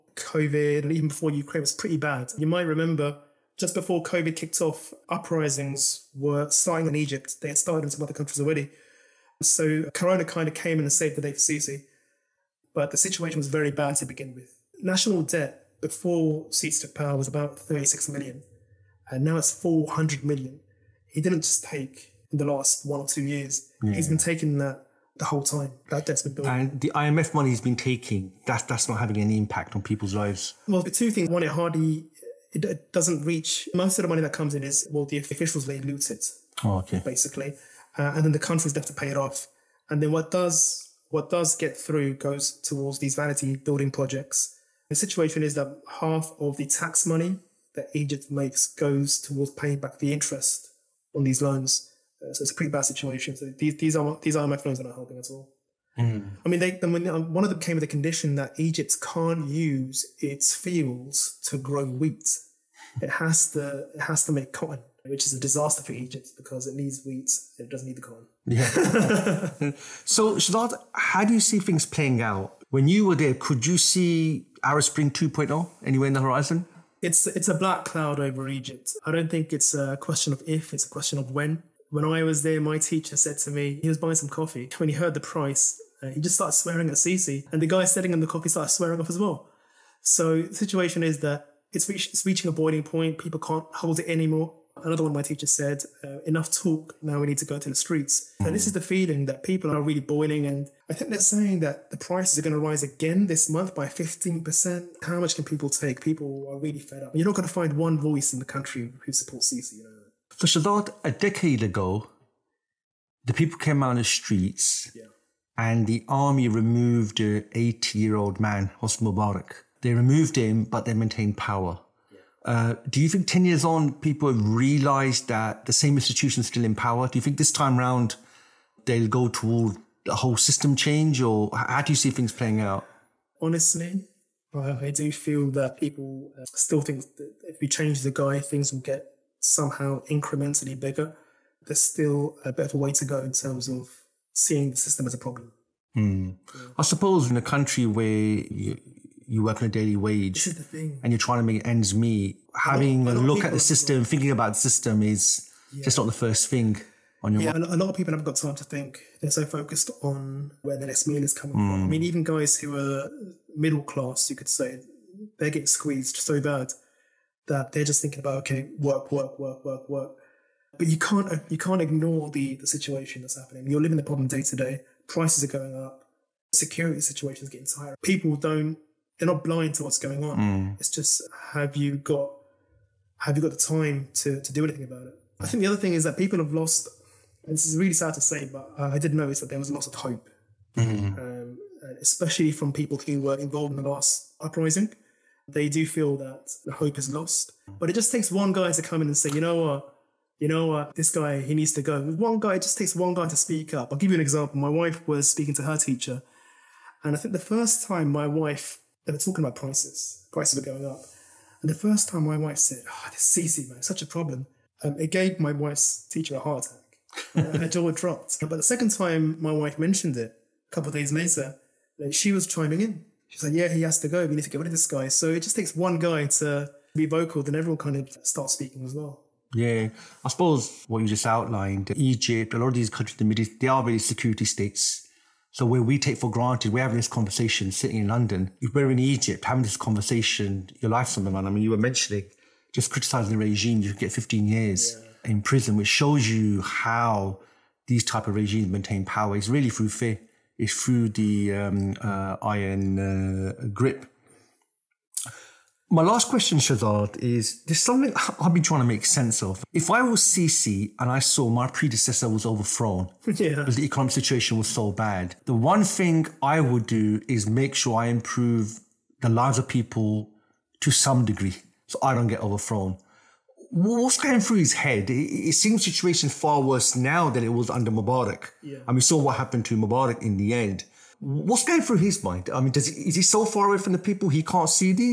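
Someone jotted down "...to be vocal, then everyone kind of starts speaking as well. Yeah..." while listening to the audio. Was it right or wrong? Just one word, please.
right.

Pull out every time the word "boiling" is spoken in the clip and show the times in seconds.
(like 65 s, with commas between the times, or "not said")
92 s, 100 s.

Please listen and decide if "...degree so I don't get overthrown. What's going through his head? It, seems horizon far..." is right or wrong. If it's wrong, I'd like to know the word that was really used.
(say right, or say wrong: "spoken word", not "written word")
wrong: "situation", not "horizon".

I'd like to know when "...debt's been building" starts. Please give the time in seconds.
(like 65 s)
26 s.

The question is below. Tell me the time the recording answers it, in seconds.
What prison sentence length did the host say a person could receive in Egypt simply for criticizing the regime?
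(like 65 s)
244 s.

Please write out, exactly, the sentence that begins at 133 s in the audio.
Honestly, I do feel that people uh, still think that if we change the guy, things will get somehow incrementally bigger.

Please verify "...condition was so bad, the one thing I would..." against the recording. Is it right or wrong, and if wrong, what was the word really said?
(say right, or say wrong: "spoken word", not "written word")
wrong: "situation", not "condition".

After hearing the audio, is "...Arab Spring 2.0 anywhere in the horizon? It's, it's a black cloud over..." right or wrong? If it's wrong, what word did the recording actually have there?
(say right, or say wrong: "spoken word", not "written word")
right.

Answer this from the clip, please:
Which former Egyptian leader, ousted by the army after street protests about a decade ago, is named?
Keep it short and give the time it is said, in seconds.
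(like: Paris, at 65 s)
Hosni Mubarak, at 118 s.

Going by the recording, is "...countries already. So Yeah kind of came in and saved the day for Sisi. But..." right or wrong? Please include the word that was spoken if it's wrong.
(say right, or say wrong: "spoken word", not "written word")
wrong: "Corona", not "Yeah".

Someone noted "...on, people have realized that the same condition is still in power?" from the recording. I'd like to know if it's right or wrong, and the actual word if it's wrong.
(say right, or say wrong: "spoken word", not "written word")
wrong: "institution", not "condition".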